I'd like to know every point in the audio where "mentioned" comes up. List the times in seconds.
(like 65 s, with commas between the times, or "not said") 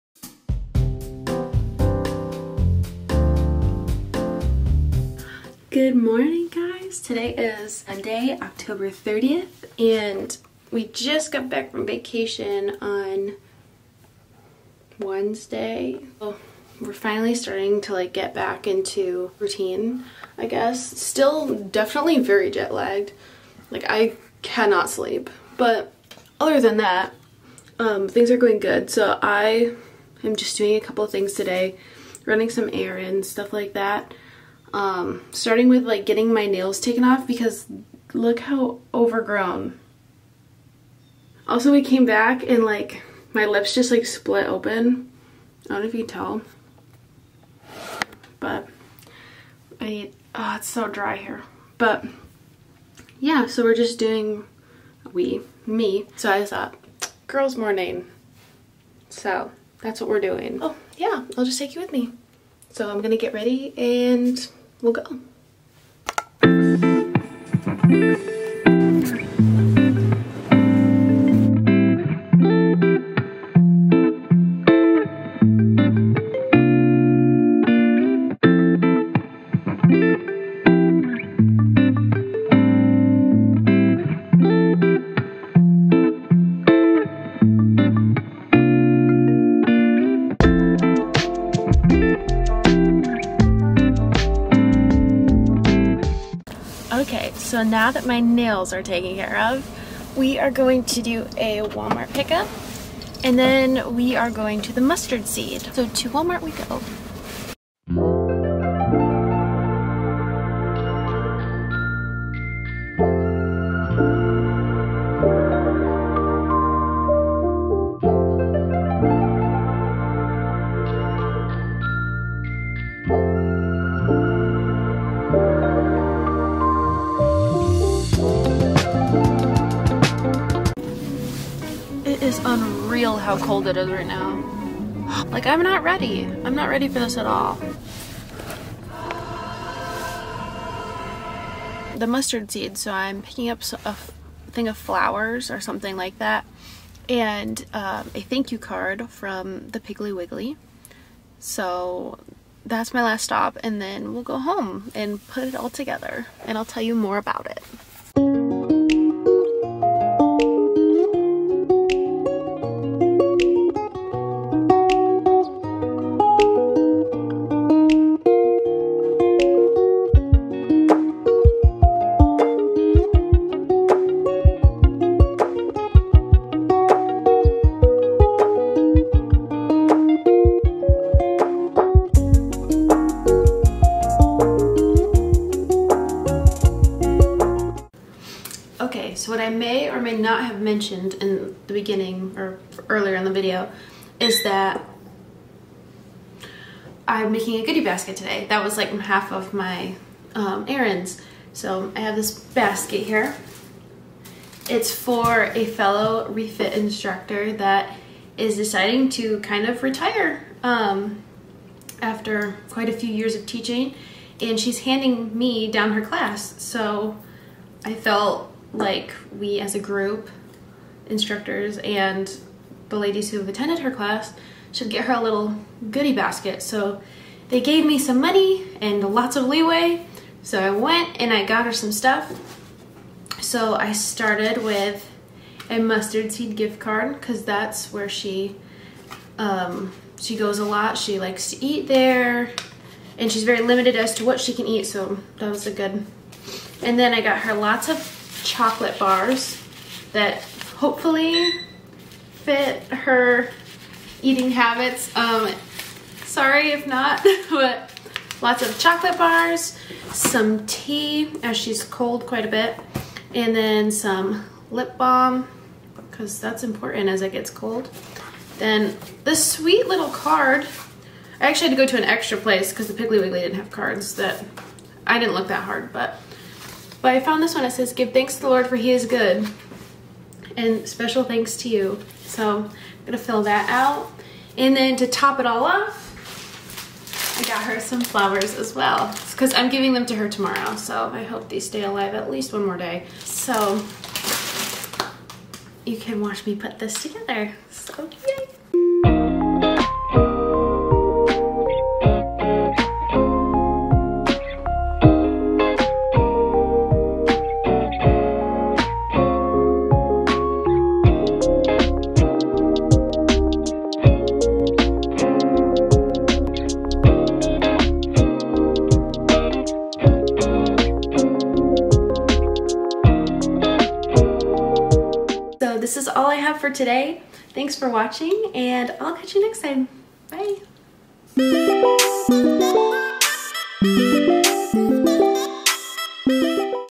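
190 s.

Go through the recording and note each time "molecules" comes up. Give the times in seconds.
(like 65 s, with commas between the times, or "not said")
not said.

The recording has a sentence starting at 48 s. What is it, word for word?
But I need, oh, it's so dry here.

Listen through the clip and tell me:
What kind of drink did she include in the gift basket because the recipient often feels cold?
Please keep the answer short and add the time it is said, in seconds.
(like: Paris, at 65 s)
Tea, at 260 s.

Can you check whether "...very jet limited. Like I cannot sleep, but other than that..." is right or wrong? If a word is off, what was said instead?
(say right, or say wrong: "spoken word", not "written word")
wrong: "lagged", not "limited".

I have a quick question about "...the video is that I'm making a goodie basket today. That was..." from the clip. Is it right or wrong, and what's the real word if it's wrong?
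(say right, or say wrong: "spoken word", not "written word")
right.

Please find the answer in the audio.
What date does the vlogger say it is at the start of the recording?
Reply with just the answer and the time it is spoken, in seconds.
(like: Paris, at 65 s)
Monday, October 30th, at 7 s.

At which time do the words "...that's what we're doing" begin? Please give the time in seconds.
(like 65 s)
59 s.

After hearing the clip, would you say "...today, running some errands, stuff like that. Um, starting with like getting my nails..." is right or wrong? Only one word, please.
right.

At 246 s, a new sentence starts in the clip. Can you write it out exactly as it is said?
And then I got her lots of chocolate bars that hopefully fit her eating habits.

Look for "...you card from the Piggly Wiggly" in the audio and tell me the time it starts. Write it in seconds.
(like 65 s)
148 s.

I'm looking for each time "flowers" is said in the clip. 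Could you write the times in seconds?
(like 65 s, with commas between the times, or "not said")
144 s, 288 s.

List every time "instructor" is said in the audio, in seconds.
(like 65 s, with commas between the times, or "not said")
206 s, 221 s.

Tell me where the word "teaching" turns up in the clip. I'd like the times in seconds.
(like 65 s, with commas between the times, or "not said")
213 s.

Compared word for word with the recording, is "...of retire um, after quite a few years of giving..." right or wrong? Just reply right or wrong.
wrong.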